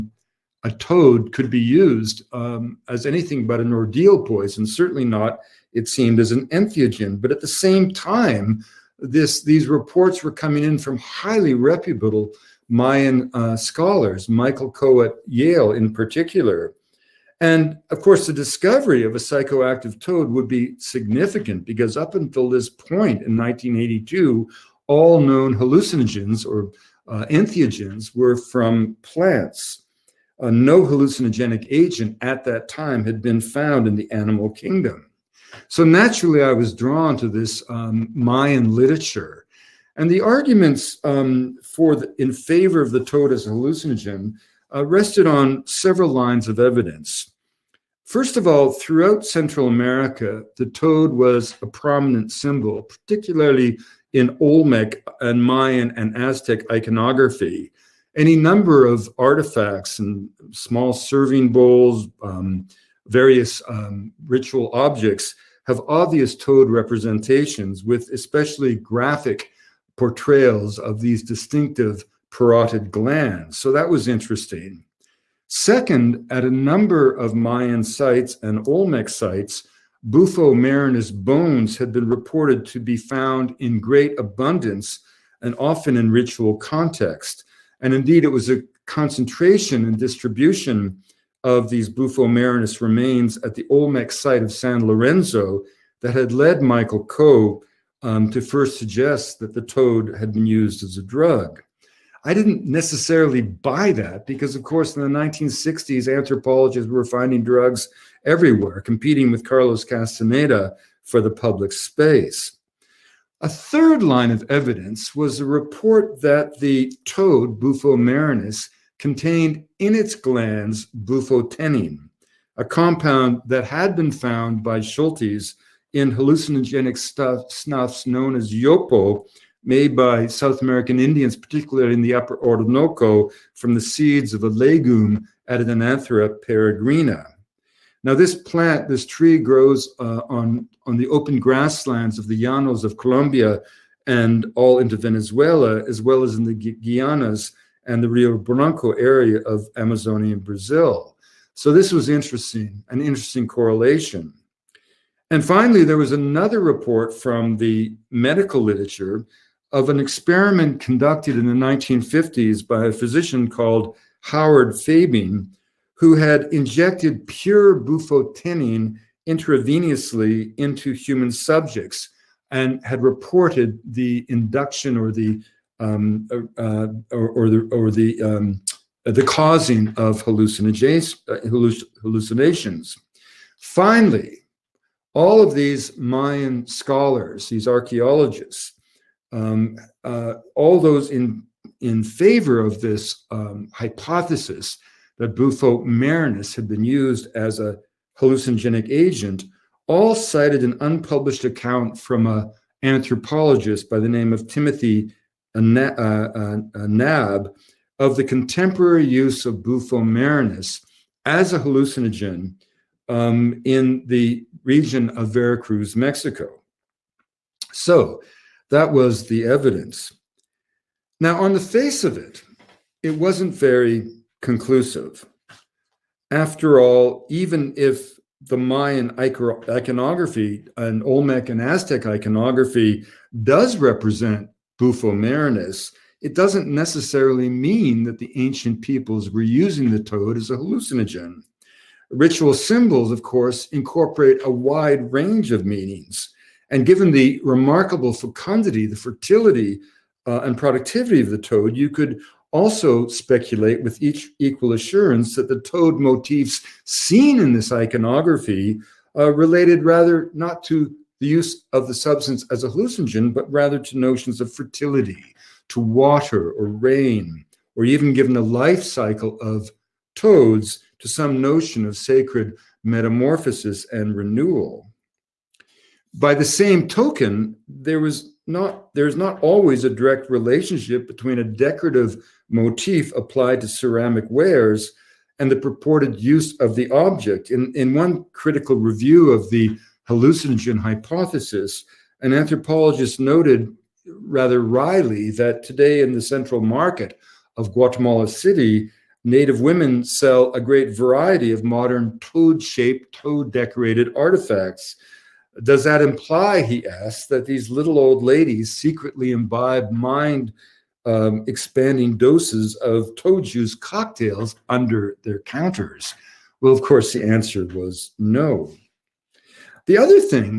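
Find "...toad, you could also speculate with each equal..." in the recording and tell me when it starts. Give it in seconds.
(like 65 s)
251 s.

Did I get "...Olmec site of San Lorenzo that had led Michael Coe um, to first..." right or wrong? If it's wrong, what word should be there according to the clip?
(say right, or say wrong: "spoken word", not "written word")
right.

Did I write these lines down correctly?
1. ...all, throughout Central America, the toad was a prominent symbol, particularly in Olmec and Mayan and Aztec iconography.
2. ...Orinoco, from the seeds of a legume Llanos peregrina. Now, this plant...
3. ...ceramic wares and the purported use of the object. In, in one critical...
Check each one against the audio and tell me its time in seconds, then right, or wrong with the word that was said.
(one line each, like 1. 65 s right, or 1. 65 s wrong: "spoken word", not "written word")
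1. 48 s right
2. 132 s wrong: "Anadenanthera", not "Llanos"
3. 283 s right.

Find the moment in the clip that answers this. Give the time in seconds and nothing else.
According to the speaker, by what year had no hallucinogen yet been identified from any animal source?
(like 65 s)
23 s.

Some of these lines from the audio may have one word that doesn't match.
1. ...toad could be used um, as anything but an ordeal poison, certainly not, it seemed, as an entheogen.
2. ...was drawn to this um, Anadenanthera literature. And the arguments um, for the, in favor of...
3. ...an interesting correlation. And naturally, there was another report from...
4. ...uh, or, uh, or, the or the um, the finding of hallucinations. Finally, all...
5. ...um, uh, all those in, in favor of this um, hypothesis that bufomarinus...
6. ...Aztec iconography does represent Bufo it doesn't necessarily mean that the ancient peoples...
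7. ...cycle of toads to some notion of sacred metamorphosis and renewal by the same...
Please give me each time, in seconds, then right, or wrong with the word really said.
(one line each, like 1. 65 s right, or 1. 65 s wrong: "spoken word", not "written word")
1. 0 s right
2. 36 s wrong: "Mayan", not "Anadenanthera"
3. 152 s wrong: "finally", not "naturally"
4. 176 s wrong: "causing", not "finding"
5. 189 s right
6. 231 s right
7. 268 s right.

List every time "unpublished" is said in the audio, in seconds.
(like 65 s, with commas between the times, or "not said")
200 s.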